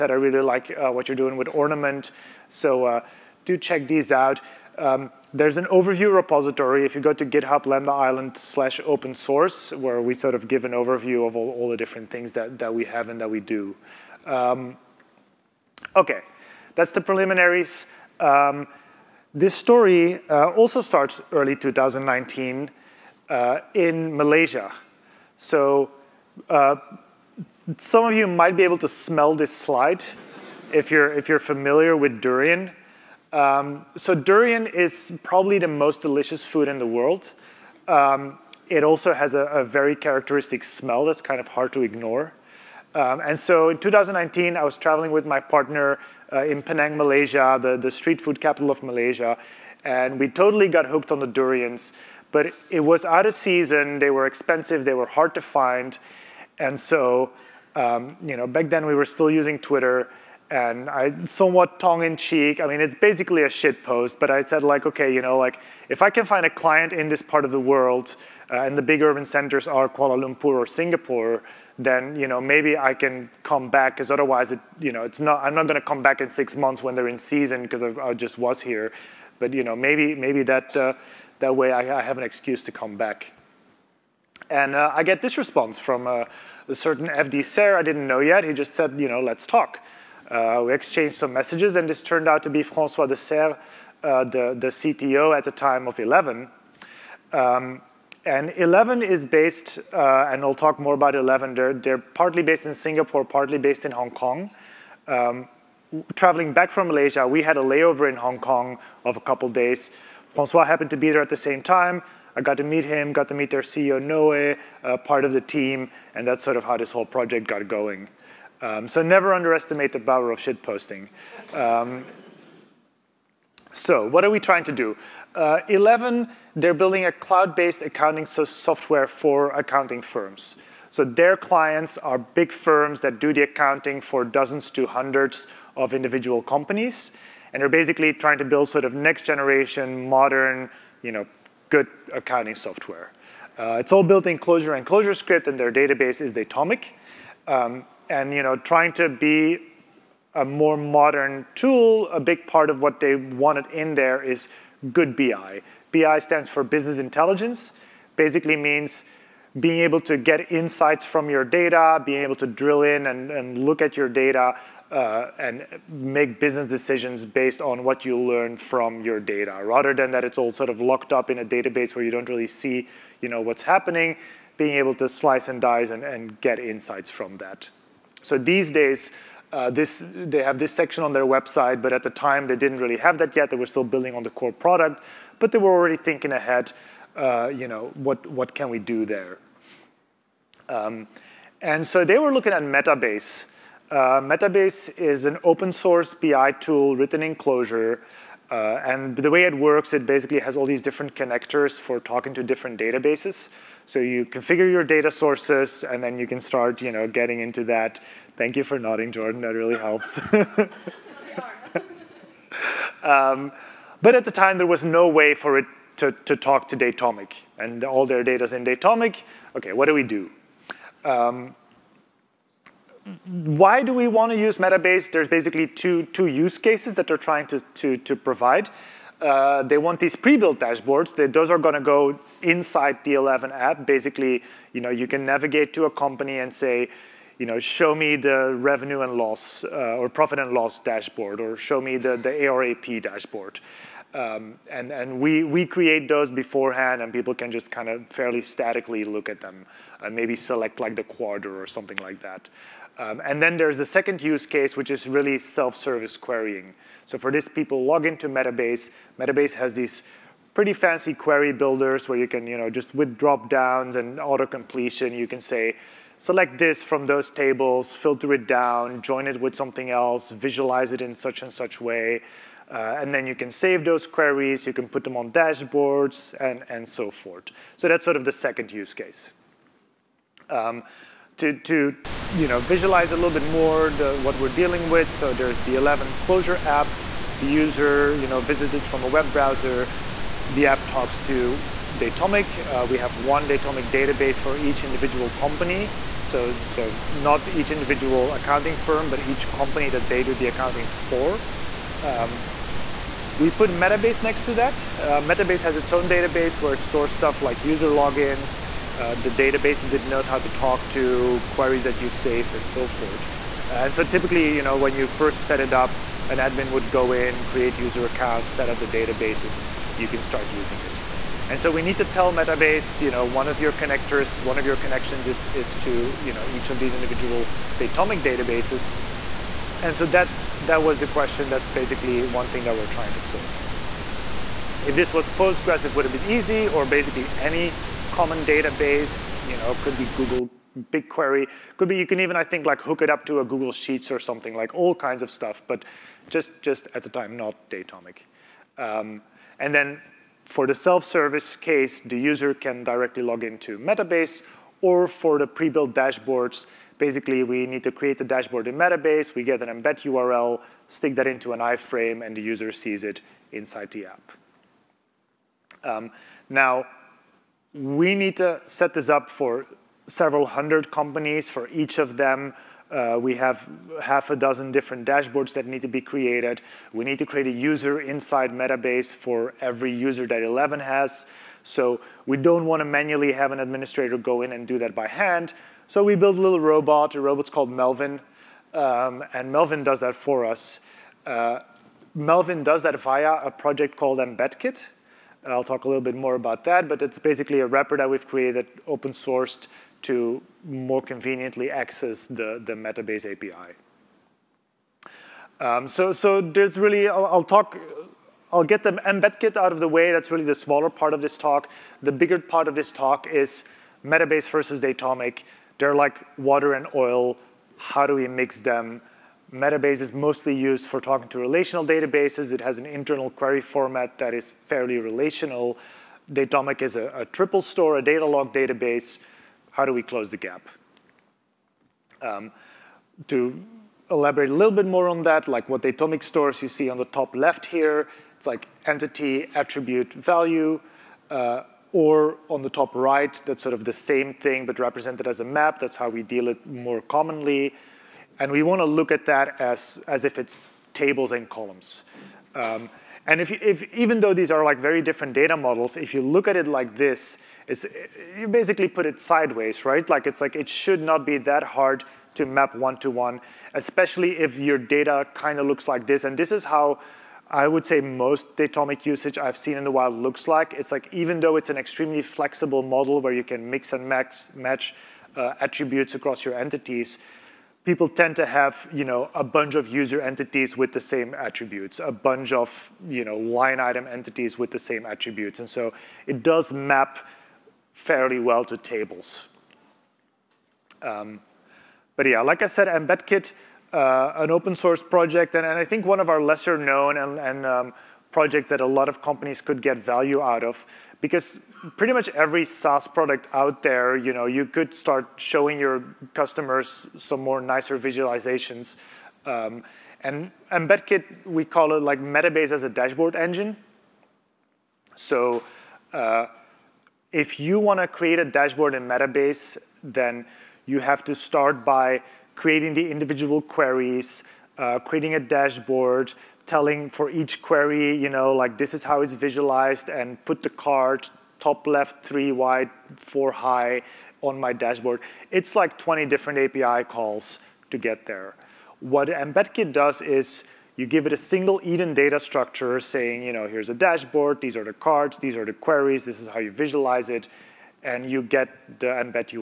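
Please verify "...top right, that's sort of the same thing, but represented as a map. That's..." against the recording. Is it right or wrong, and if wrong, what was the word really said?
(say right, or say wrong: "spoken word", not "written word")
right.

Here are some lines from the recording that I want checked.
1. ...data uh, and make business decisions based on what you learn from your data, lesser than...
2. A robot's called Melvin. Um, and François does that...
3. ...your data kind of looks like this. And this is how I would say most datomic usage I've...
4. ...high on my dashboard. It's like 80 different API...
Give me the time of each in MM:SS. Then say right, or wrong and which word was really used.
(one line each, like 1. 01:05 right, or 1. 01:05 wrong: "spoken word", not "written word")
1. 02:44 wrong: "rather", not "lesser"
2. 06:27 wrong: "Melvin", not "François"
3. 07:44 right
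4. 08:53 wrong: "20", not "80".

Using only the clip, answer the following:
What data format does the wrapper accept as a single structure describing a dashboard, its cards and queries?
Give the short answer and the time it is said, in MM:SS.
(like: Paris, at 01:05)
EDN, at 09:01.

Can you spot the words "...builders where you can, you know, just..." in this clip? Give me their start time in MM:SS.
04:21.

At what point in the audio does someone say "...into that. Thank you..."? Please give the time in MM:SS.
03:27.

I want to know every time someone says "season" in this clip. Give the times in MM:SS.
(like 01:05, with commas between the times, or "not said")
00:53, 01:17.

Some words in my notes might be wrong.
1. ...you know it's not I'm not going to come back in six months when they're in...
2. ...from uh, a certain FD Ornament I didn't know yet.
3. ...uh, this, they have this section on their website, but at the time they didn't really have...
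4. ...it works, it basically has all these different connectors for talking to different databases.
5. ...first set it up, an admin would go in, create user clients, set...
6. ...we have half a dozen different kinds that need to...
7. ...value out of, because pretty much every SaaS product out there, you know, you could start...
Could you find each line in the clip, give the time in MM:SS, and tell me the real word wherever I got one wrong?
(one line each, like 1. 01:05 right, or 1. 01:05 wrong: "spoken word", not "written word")
1. 01:14 right
2. 01:25 wrong: "Ser", not "Ornament"
3. 02:59 right
4. 03:19 right
5. 05:15 wrong: "accounts", not "clients"
6. 06:13 wrong: "dashboards", not "kinds"
7. 08:19 right.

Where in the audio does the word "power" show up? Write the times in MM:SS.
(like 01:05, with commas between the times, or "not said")
02:00.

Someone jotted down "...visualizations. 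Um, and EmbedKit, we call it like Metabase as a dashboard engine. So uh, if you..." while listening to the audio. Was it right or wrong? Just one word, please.
right.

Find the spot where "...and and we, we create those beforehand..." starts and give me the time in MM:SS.
04:04.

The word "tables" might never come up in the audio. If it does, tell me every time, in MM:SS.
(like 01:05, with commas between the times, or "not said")
04:27, 07:30, 08:08.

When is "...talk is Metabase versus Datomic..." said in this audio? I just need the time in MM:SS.
06:52.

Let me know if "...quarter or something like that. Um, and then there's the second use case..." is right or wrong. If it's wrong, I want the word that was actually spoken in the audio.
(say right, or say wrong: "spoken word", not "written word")
right.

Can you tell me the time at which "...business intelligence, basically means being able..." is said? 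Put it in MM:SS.
02:36.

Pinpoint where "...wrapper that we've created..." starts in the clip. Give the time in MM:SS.
06:37.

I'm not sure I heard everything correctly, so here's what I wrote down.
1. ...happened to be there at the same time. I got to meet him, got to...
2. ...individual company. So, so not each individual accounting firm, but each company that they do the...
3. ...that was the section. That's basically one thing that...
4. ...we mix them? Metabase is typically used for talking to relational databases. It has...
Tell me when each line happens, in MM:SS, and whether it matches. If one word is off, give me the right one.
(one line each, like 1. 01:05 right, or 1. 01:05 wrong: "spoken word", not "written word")
1. 01:50 right
2. 04:54 right
3. 05:30 wrong: "question", not "section"
4. 06:58 wrong: "mostly", not "typically".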